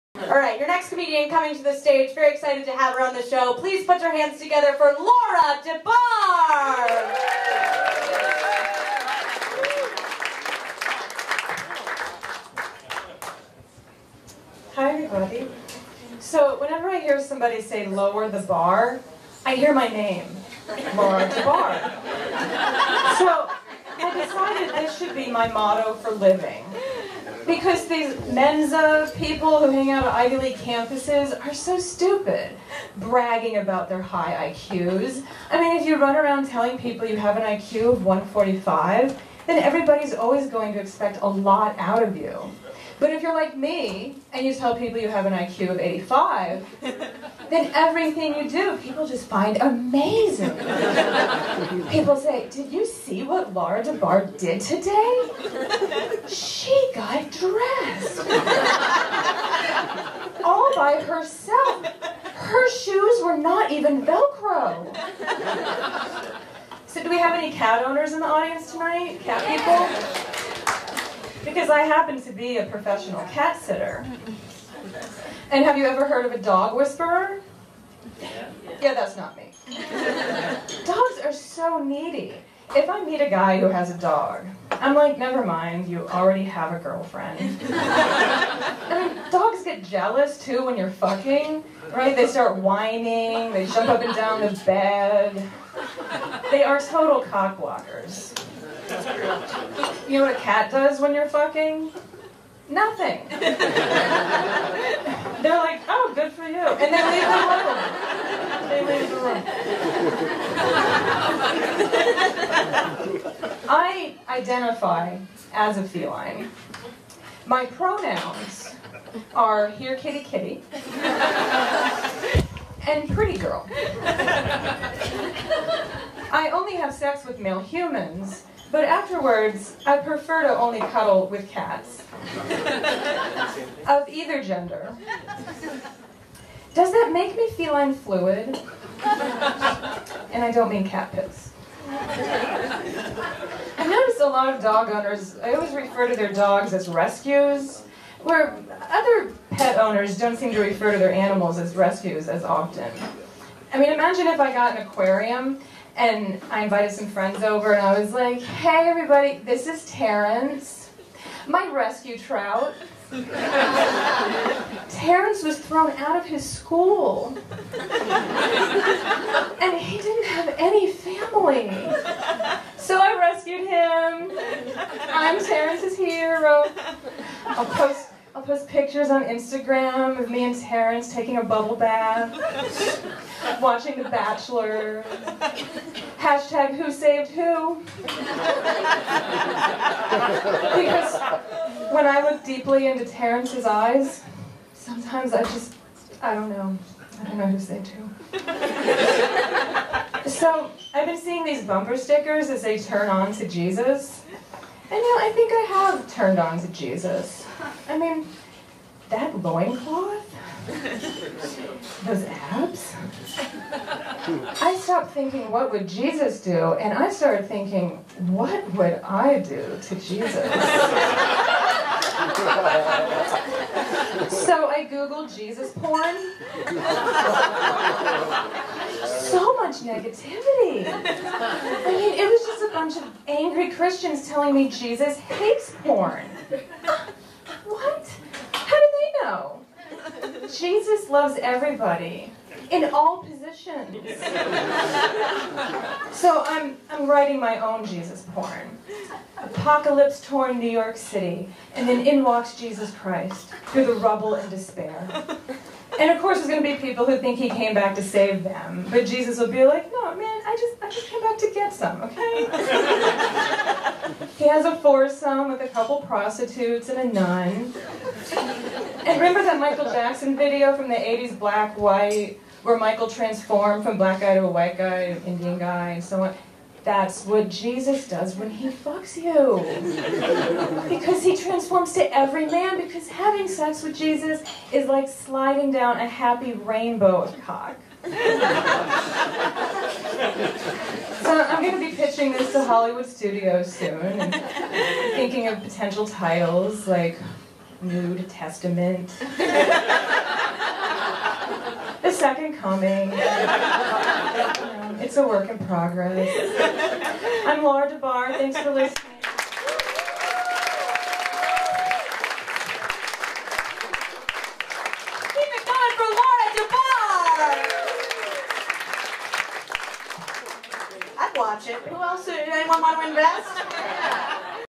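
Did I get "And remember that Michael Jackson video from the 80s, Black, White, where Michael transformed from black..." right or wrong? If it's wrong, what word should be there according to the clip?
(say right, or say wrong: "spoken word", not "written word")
right.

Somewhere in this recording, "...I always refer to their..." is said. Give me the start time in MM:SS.
02:25.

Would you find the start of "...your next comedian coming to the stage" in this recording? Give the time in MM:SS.
00:00.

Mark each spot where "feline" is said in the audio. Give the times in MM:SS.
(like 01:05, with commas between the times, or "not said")
01:55, 02:17.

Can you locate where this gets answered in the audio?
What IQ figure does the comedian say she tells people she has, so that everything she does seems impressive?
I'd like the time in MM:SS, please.
00:45.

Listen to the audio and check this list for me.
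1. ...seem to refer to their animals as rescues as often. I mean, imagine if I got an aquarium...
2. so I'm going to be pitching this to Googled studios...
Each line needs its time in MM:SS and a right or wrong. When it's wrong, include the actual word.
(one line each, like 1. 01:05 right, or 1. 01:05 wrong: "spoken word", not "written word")
1. 02:30 right
2. 04:48 wrong: "Hollywood", not "Googled".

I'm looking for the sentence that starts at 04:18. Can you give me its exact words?
But Jesus will be like, no, man, I just, I just came back to get some, okay?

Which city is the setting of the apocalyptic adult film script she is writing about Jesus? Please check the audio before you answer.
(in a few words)
New York City.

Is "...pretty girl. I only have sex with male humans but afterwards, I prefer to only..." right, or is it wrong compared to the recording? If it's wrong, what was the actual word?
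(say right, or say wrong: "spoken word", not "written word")
right.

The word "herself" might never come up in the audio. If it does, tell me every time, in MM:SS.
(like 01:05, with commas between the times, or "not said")
01:01.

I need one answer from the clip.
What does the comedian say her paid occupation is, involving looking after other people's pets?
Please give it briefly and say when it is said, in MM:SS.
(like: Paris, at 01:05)
Professional cat sitter, at 01:12.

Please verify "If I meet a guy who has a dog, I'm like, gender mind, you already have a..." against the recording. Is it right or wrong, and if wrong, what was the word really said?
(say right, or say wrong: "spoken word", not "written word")
wrong: "never", not "gender".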